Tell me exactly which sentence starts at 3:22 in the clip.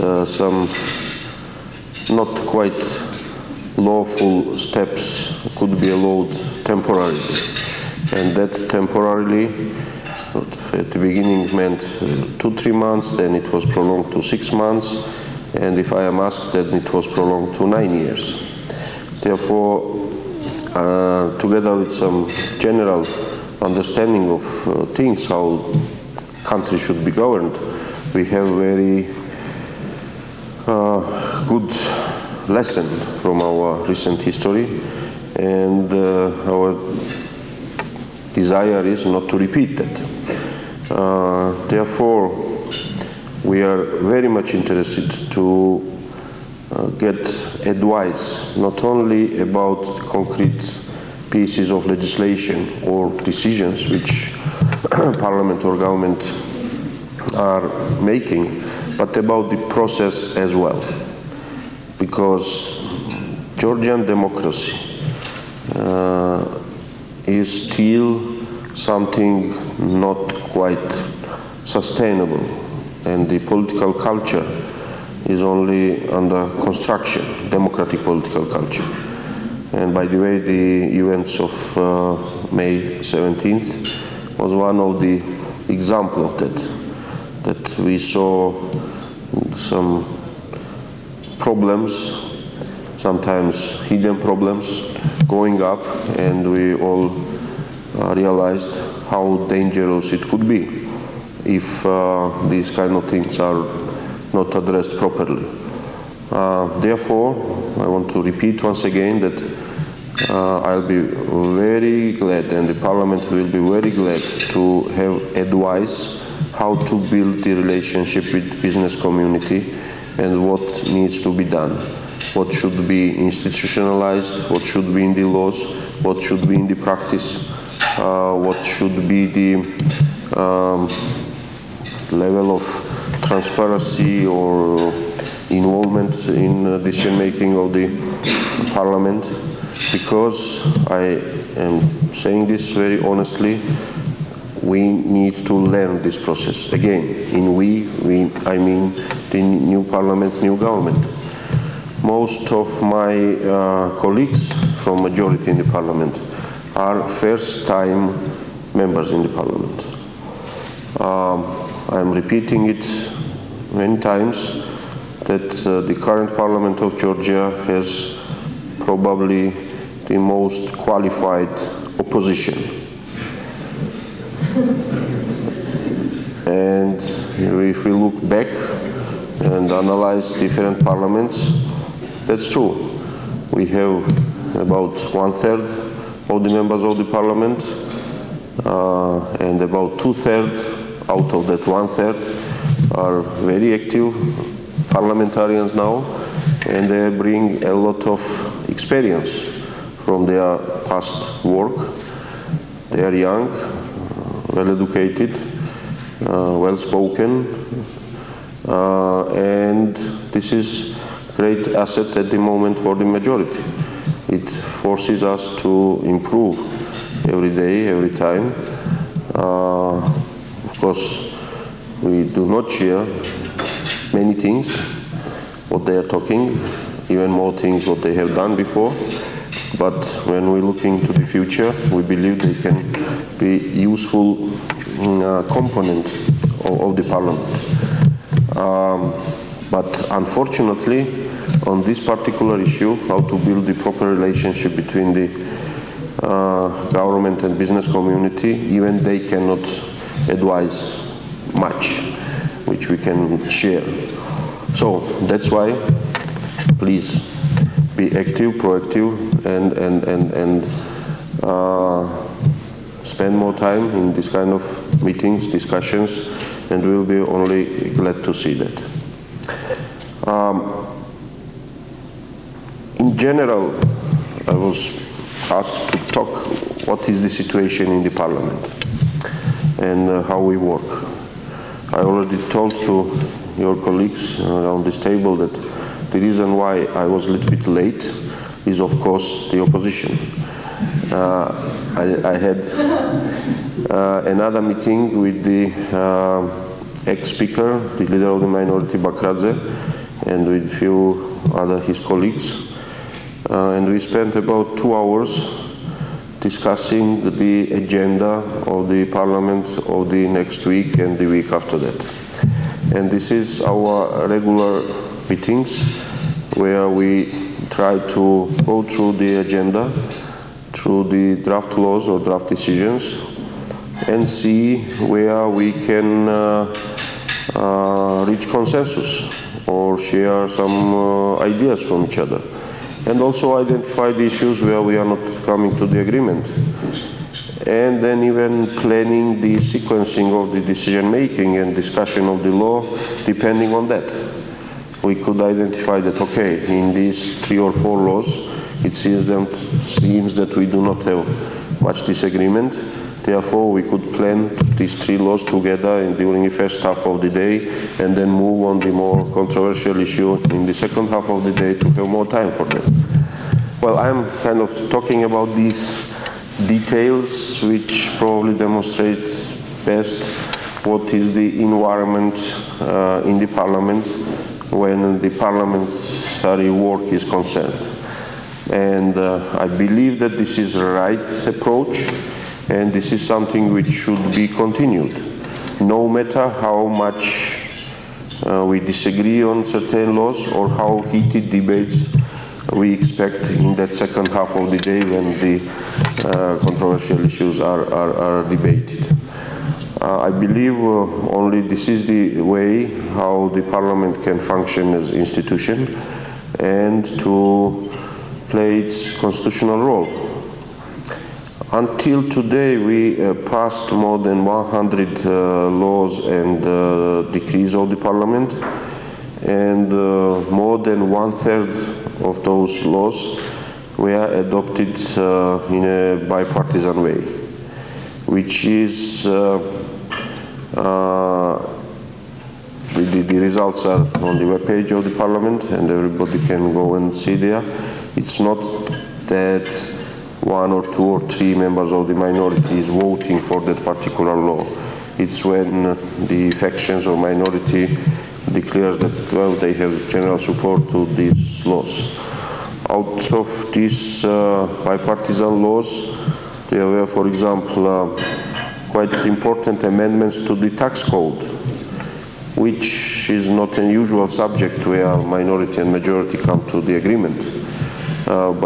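They are young, well-educated, uh, well-spoken, uh, and this is great asset at the moment for the majority.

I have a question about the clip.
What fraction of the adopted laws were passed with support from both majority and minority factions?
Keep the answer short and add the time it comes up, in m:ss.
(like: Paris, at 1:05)
more than one third, at 7:00.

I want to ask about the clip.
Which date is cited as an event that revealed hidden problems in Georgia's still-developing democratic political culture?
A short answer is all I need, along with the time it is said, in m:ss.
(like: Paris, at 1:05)
May 17th, at 1:22.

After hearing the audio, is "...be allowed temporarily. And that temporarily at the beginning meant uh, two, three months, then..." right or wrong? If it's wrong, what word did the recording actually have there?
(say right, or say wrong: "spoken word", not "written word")
right.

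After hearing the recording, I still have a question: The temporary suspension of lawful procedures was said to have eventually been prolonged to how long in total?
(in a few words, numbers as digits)
9 years.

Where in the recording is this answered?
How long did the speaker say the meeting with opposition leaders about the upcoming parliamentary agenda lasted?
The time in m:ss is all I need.
5:04.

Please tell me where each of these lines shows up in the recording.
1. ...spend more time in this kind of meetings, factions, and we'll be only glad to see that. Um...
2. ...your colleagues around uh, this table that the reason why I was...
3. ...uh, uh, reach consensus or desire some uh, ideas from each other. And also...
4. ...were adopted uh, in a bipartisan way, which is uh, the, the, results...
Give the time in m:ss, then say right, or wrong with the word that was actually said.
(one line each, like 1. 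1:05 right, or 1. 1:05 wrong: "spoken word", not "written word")
1. 4:23 wrong: "discussions", not "factions"
2. 4:43 right
3. 5:26 wrong: "share", not "desire"
4. 7:03 right.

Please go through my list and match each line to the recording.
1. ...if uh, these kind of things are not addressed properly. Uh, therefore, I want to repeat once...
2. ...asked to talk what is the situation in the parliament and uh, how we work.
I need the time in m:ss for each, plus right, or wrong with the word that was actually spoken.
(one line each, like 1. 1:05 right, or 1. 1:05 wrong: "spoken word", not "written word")
1. 1:41 right
2. 4:35 right.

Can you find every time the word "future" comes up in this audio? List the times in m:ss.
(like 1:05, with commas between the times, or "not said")
3:51.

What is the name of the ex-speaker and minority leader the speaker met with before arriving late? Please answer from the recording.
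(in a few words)
Bakradze.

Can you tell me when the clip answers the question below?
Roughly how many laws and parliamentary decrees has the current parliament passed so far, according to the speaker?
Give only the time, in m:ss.
6:53.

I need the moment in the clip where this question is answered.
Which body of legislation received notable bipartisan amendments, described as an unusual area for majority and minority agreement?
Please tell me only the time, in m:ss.
7:40.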